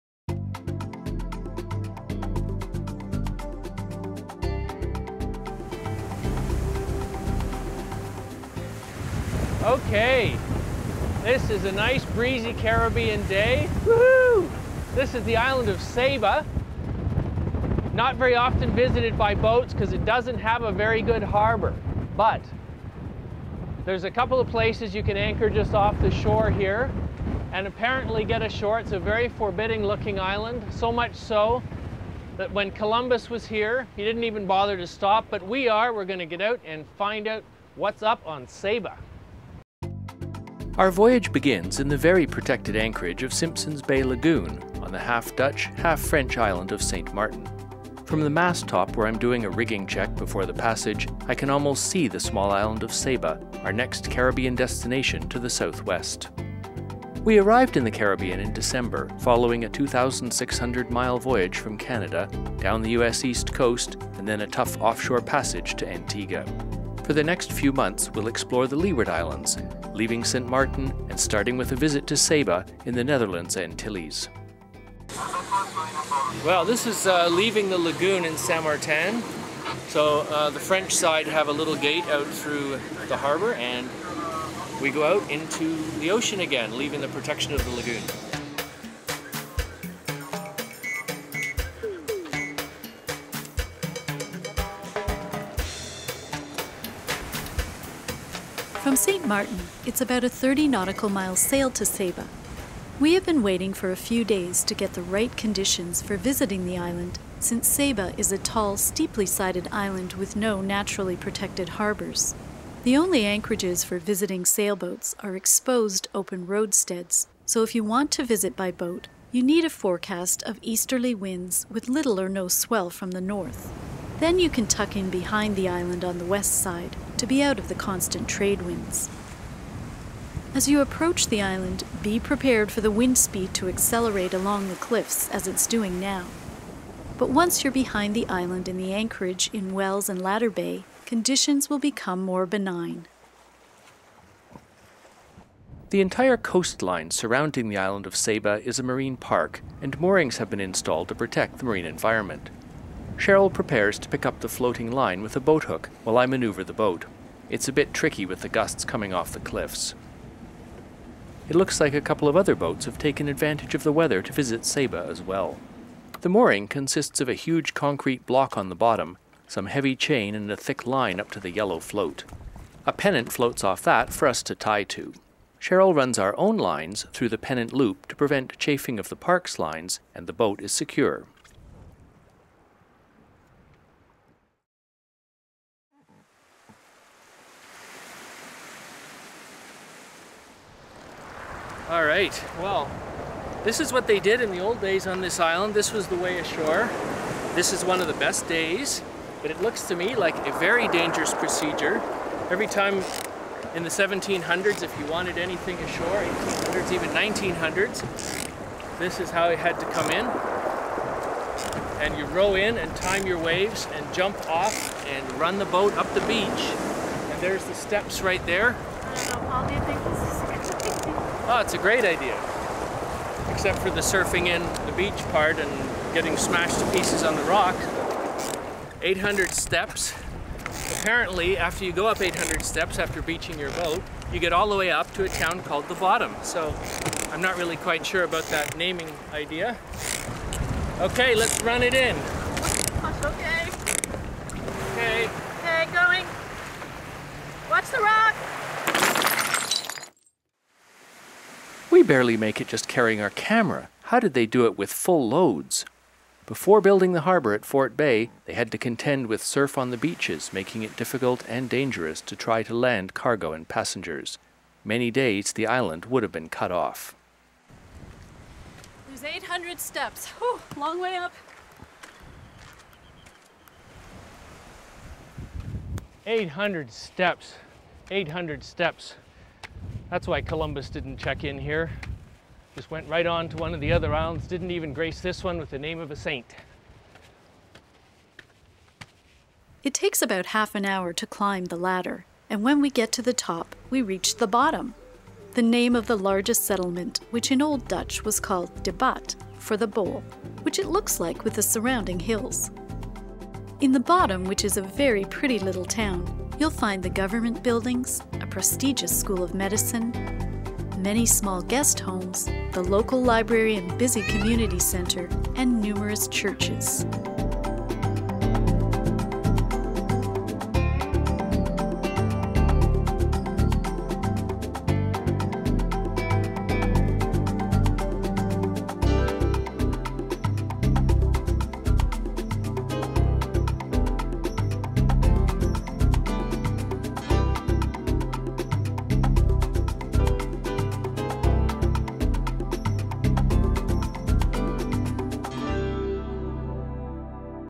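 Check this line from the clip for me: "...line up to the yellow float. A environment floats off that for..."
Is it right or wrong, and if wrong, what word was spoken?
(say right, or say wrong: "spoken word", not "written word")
wrong: "pennant", not "environment".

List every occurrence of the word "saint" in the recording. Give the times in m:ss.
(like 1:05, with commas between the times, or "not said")
1:18, 4:46.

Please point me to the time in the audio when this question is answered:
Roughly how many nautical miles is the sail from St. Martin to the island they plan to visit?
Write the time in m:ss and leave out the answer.
1:40.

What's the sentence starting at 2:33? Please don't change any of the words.
Sheryl prepares to pick up the floating line with a boat hook while I maneuver the boat.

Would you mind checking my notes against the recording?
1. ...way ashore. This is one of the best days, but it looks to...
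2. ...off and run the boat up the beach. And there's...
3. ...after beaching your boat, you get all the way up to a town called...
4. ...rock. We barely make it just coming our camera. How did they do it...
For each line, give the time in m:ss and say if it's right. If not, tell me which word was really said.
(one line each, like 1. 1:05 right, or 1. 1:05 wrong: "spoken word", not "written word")
1. 3:16 right
2. 3:34 right
3. 3:52 right
4. 4:08 wrong: "carrying", not "coming".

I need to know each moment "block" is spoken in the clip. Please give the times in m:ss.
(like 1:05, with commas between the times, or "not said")
2:48.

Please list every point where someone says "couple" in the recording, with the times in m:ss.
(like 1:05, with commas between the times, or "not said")
0:24, 2:41.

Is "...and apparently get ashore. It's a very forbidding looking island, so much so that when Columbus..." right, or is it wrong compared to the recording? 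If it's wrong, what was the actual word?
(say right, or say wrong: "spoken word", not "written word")
right.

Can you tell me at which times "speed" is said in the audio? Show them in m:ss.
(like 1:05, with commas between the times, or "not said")
2:13.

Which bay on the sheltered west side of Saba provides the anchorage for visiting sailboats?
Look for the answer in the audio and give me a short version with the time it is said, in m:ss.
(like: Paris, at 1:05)
Wells and Ladder Bay, at 2:19.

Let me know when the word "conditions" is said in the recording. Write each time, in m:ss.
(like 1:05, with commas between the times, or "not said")
1:45, 2:21.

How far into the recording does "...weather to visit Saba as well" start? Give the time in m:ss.
2:43.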